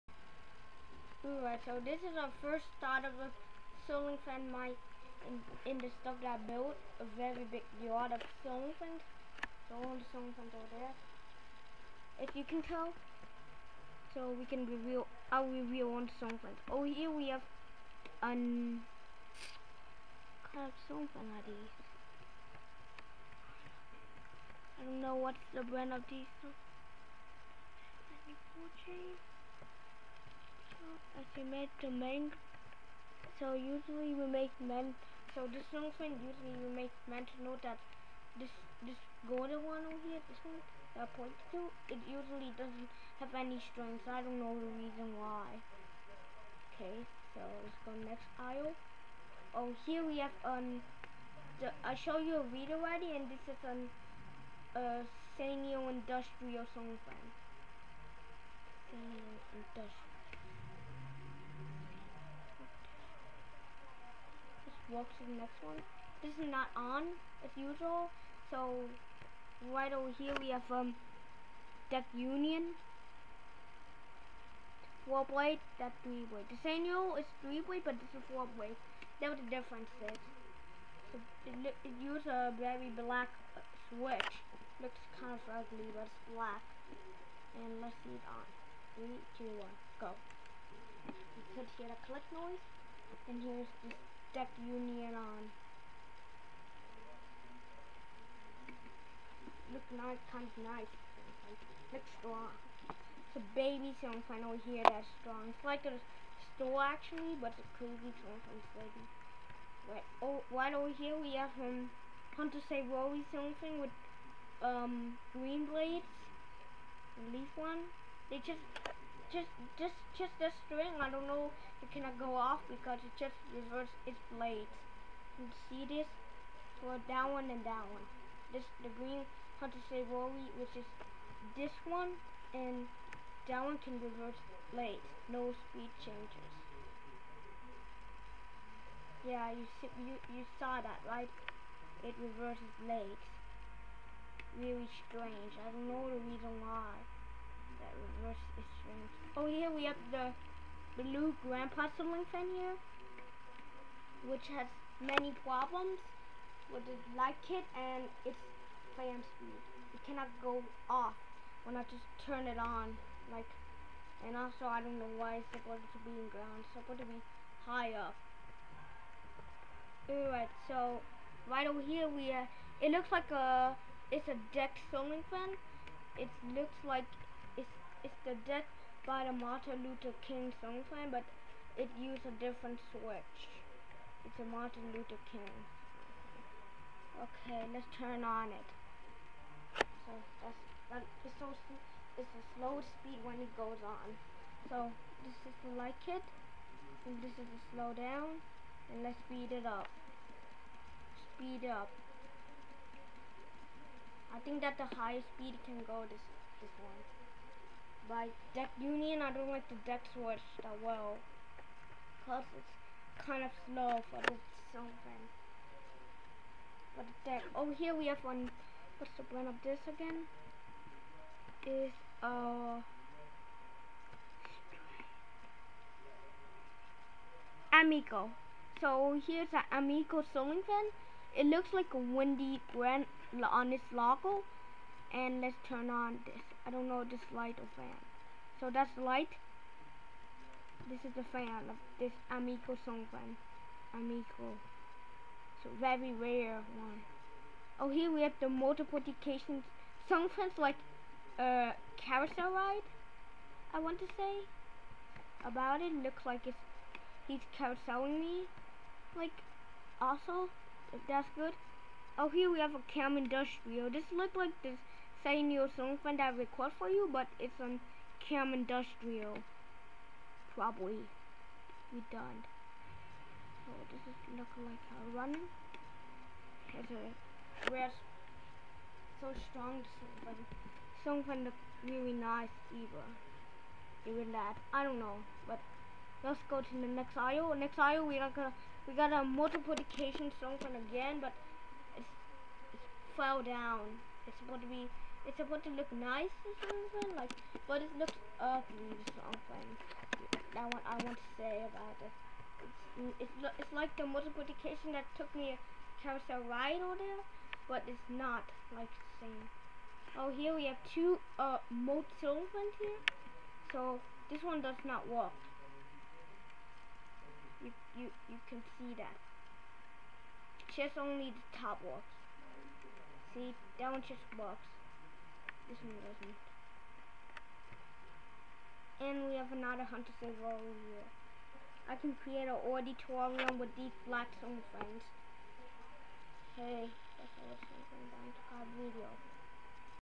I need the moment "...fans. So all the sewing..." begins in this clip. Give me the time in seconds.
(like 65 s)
8 s.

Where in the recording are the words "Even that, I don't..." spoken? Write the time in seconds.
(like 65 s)
284 s.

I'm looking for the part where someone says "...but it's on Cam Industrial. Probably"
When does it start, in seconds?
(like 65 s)
267 s.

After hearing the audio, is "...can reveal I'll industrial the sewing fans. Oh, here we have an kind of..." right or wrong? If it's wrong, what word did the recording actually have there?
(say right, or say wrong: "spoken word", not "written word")
wrong: "reveal", not "industrial".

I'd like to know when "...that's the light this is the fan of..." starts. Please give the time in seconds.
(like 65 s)
238 s.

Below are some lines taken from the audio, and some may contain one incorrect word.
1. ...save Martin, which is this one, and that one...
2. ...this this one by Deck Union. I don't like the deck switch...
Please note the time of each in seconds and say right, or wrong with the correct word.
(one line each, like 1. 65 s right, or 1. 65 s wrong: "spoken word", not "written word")
1. 129 s wrong: "Wally", not "Martin"
2. 206 s right.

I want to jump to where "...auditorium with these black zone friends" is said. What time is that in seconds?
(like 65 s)
332 s.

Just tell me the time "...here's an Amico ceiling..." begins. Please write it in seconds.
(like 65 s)
229 s.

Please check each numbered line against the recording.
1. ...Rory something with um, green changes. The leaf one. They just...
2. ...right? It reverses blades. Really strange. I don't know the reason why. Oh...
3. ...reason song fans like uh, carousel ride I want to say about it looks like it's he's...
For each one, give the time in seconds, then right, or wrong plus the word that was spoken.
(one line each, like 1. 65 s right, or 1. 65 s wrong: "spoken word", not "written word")
1. 112 s wrong: "blades", not "changes"
2. 141 s right
3. 248 s wrong: "multiplication", not "reason".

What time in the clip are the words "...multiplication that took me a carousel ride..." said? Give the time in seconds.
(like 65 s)
304 s.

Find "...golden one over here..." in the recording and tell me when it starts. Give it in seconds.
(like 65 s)
39 s.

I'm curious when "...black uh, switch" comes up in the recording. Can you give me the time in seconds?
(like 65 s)
82 s.